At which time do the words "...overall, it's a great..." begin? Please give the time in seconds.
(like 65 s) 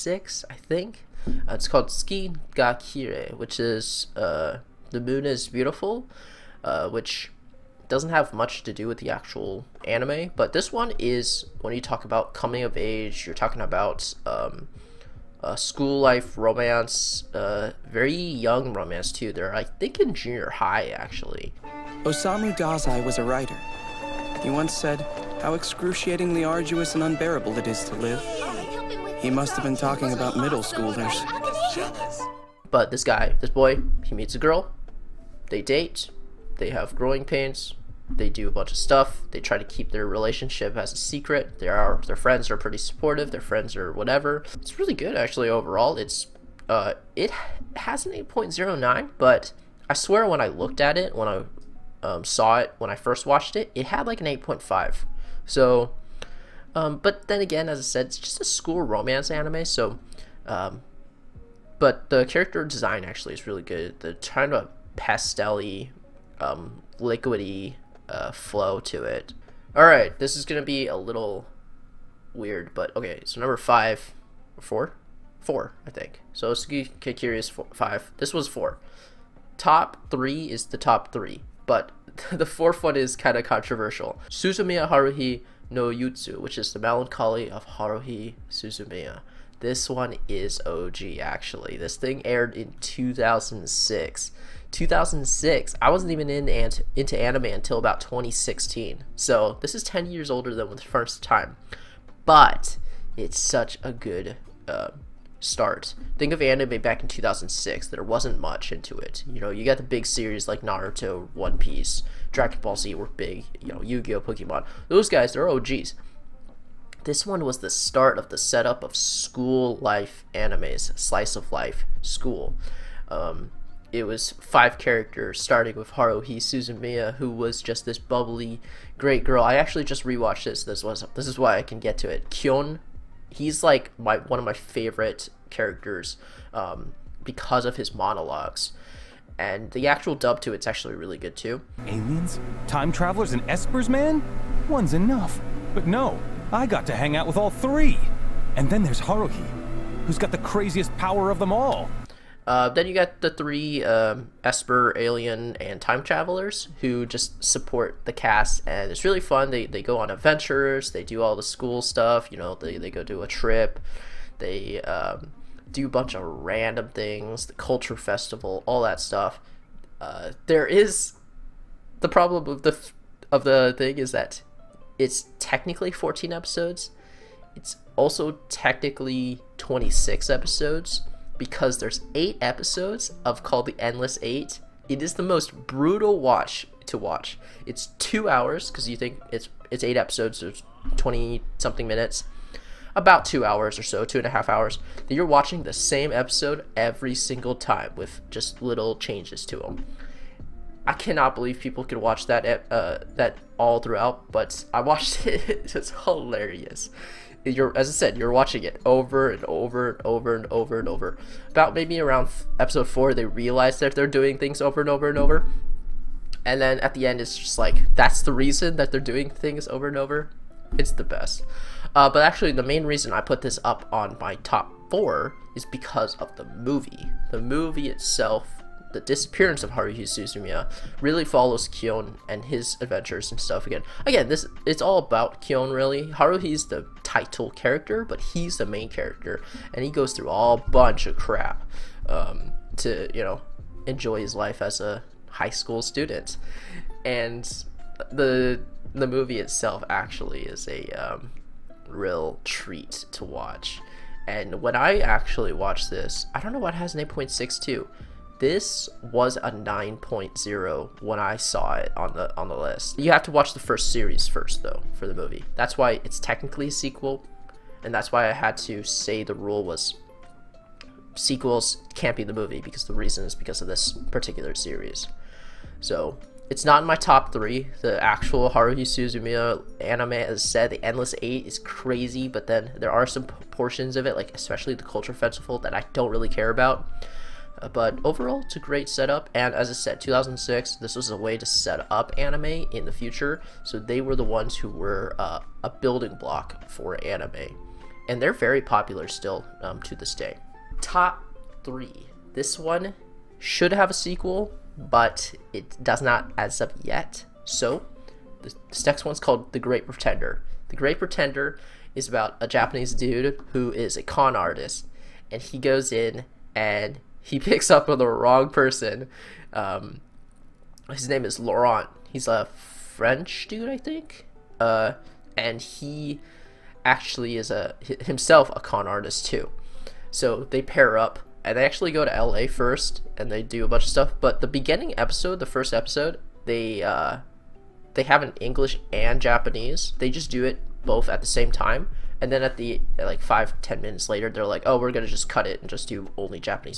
288 s.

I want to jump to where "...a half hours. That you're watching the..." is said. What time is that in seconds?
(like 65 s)
194 s.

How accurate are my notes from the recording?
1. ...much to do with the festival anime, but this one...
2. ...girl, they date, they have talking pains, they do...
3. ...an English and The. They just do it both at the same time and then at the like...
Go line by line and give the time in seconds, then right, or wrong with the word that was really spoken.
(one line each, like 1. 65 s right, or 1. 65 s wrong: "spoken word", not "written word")
1. 8 s wrong: "actual", not "festival"
2. 34 s wrong: "growing", not "talking"
3. 338 s wrong: "Japanese", not "The".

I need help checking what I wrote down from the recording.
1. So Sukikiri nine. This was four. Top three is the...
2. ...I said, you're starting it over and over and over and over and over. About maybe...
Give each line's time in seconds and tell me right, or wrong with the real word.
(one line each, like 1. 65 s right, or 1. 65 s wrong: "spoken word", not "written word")
1. 76 s wrong: "five", not "nine"
2. 207 s wrong: "watching", not "starting".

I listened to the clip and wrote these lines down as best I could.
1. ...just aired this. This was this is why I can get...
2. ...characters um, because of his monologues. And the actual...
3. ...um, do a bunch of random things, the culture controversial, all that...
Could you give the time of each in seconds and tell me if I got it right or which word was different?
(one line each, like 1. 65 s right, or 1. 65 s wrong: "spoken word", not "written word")
1. 129 s wrong: "rewatched", not "aired"
2. 135 s right
3. 164 s wrong: "festival", not "controversial".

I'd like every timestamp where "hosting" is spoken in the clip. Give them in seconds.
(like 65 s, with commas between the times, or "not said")
not said.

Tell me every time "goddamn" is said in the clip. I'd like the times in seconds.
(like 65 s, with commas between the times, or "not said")
not said.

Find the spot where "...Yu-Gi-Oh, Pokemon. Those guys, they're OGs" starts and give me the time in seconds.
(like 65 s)
113 s.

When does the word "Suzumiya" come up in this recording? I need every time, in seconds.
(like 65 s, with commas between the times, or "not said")
84 s, 88 s, 126 s, 230 s, 278 s.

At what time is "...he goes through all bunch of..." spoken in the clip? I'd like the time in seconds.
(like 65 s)
239 s.